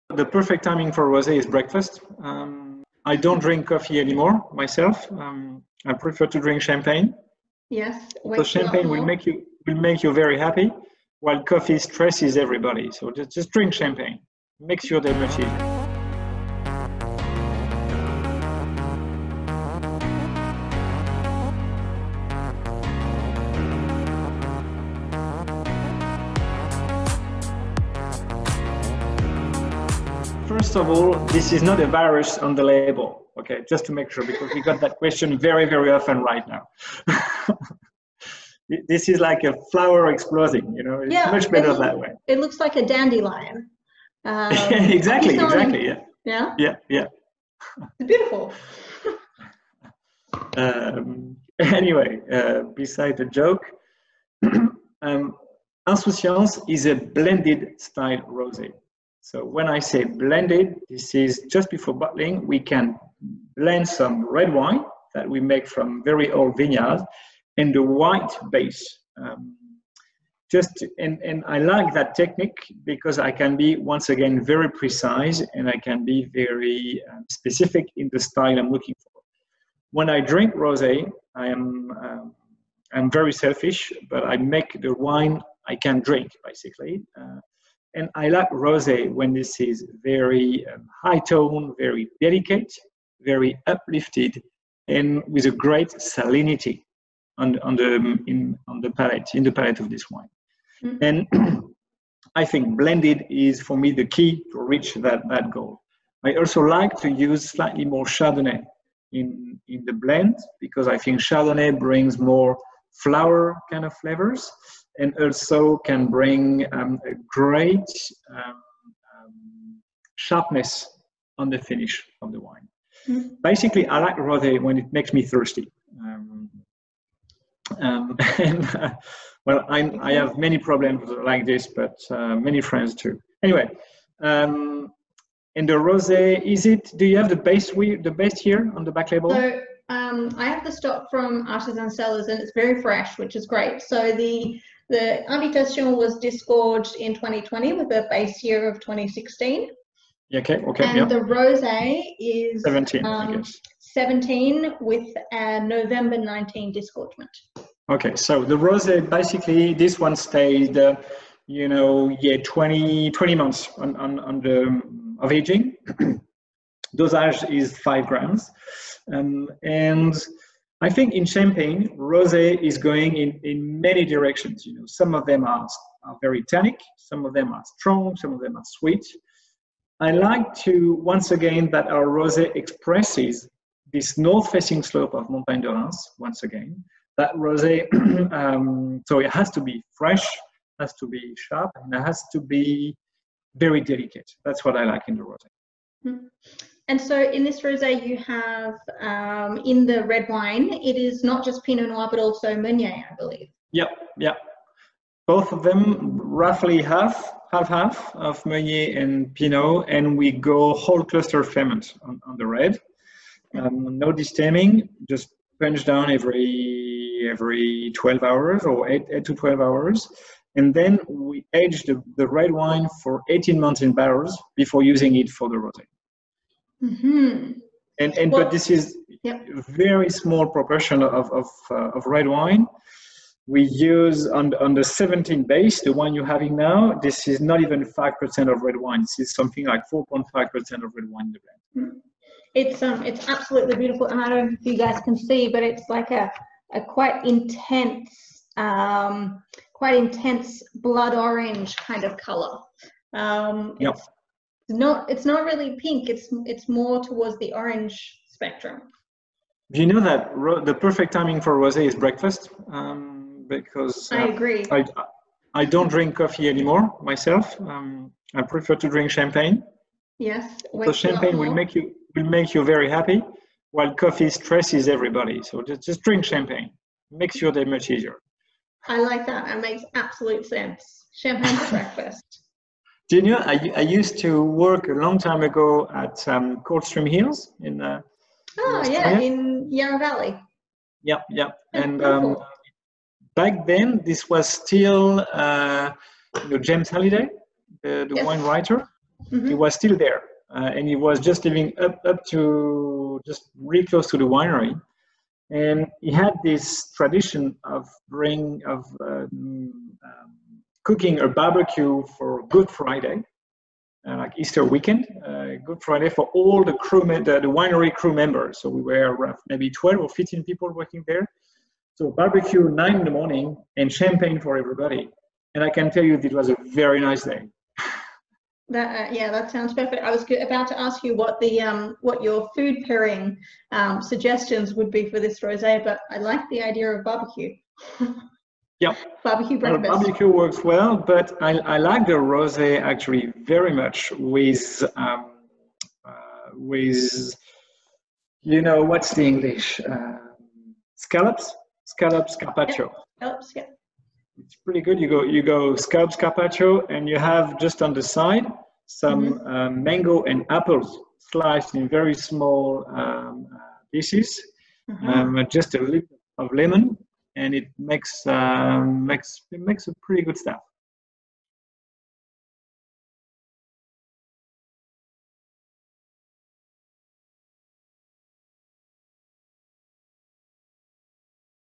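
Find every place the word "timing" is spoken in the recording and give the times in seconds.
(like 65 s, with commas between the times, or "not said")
0 s, 261 s.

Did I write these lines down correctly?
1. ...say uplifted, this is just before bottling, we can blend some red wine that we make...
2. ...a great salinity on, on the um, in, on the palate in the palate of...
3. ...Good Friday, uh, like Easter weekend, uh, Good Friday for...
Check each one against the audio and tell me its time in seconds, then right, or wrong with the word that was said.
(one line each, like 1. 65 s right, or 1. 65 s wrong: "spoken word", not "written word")
1. 59 s wrong: "blended", not "uplifted"
2. 95 s right
3. 312 s right.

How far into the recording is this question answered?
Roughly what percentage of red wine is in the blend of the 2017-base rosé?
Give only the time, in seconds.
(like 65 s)
239 s.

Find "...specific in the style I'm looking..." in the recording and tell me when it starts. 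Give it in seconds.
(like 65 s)
77 s.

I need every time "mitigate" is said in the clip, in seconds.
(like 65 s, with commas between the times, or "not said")
not said.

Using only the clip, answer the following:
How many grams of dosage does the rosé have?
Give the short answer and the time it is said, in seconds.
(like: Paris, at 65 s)
5 grams, at 167 s.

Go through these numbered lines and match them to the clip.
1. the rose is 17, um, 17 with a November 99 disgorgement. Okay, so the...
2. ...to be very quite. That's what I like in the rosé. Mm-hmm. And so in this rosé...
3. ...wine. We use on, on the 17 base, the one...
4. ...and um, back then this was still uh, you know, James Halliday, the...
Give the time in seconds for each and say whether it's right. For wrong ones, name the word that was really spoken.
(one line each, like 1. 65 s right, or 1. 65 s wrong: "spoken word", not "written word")
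1. 151 s wrong: "19", not "99"
2. 192 s wrong: "delicate", not "quite"
3. 232 s right
4. 291 s right.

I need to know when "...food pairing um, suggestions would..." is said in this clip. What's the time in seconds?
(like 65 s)
332 s.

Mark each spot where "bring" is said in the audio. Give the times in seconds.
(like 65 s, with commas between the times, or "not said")
111 s, 116 s, 308 s.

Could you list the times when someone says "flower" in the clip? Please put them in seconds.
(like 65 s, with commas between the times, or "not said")
39 s, 112 s.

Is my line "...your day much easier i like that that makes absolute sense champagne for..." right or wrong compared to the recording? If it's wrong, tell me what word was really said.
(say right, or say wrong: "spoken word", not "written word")
right.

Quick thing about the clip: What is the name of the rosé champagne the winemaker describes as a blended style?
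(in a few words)
Insouciance.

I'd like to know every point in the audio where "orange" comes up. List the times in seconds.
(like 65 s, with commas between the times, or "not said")
251 s, 257 s.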